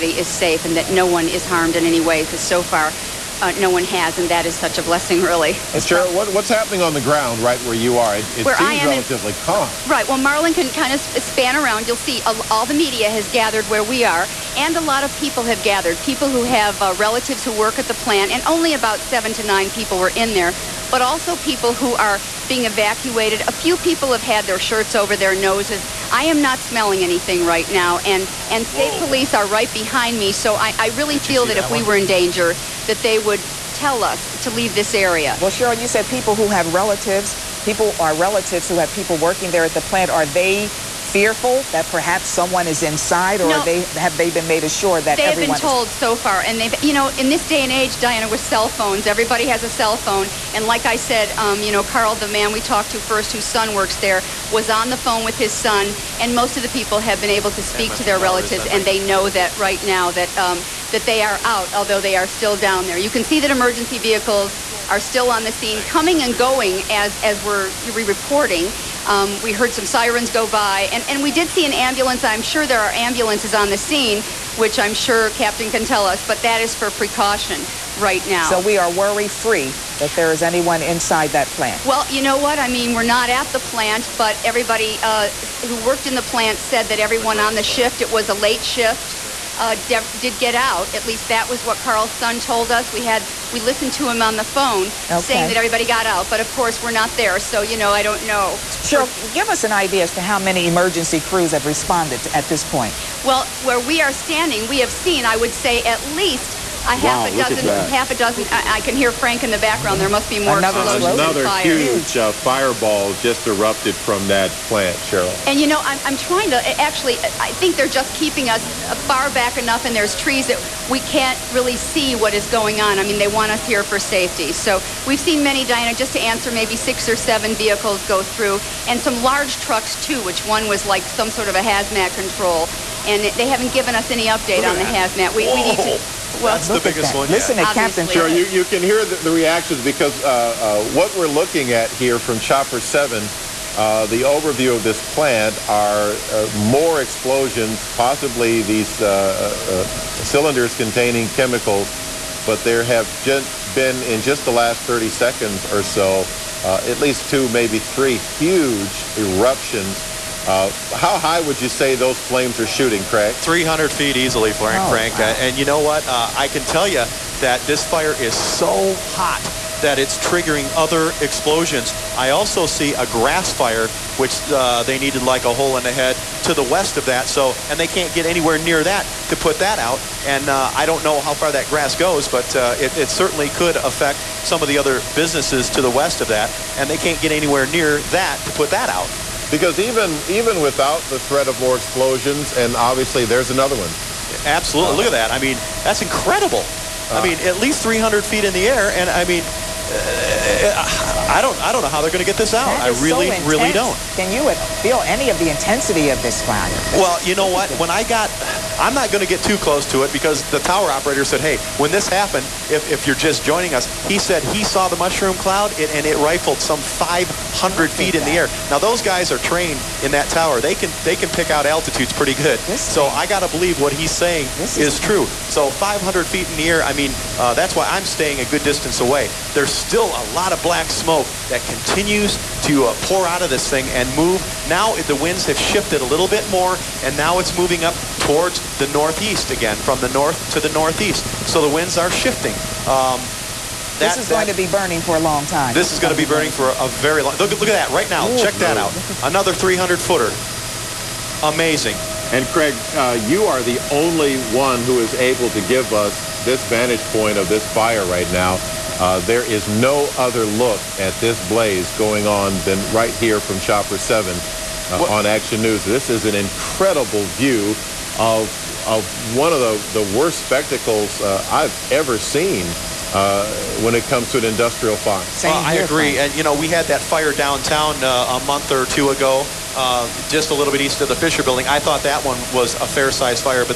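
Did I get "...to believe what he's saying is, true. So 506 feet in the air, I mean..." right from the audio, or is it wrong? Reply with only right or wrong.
wrong.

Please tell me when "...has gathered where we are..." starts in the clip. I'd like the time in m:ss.
0:13.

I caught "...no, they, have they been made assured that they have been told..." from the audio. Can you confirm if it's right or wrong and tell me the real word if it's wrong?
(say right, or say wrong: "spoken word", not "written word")
right.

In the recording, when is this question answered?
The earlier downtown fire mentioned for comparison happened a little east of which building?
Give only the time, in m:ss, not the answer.
4:41.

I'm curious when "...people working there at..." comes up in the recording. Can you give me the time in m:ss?
0:38.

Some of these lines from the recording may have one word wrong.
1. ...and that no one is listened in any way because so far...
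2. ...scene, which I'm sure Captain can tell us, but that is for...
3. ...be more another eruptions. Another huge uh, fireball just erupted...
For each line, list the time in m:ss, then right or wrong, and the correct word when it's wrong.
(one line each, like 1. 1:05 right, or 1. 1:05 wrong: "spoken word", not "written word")
1. 0:00 wrong: "harmed", not "listened"
2. 1:13 right
3. 1:50 wrong: "explosions", not "eruptions".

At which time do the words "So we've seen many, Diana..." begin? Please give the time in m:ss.
2:04.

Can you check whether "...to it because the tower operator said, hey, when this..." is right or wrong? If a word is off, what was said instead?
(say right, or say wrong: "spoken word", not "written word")
right.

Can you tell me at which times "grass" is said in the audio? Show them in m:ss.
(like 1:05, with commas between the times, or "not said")
2:53, 3:01.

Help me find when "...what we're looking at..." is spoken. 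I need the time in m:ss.
2:20.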